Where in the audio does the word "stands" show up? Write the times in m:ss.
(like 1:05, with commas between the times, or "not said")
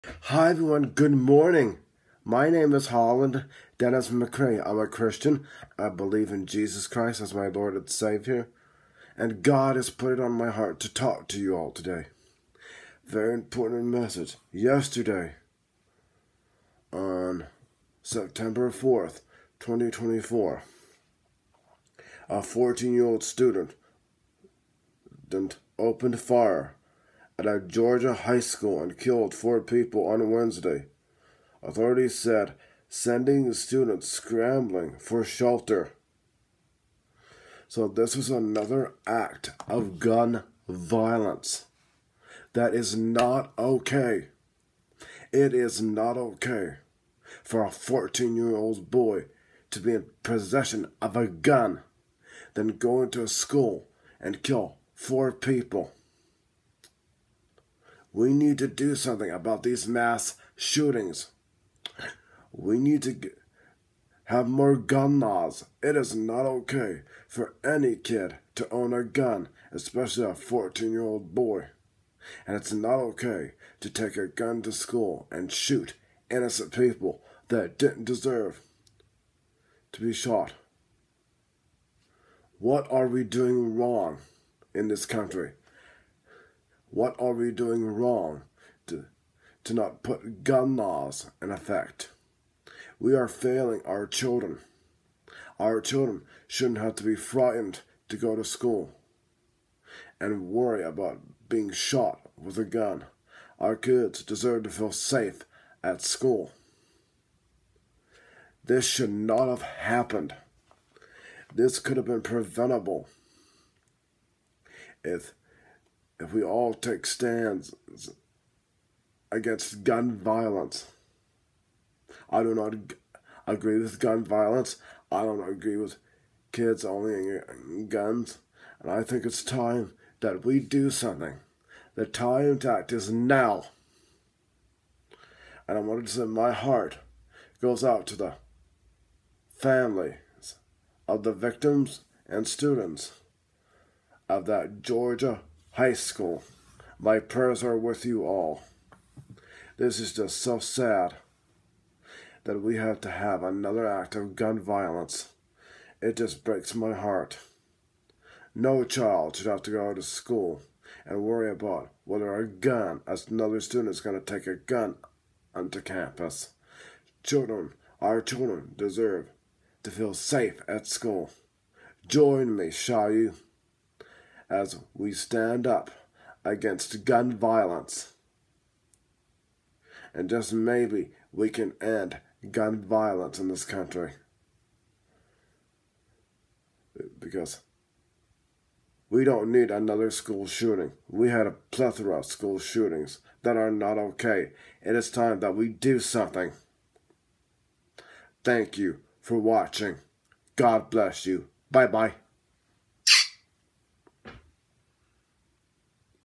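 1:57, 2:55.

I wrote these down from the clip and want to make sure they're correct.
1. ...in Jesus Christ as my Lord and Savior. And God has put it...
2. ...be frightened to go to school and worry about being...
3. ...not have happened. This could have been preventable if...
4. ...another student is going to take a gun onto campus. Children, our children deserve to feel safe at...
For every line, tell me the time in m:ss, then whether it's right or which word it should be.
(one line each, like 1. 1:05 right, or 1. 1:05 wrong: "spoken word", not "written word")
1. 0:06 right
2. 1:37 right
3. 1:49 right
4. 2:43 right.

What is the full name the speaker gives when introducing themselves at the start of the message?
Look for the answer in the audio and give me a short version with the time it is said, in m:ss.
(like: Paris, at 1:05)
Holland Dennis McRae, at 0:02.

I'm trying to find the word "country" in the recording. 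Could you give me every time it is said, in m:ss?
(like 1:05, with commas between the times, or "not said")
1:25, 3:03.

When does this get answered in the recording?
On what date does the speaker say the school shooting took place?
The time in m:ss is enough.
0:18.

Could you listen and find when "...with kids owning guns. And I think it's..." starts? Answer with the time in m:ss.
2:05.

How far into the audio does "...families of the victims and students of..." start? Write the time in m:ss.
2:19.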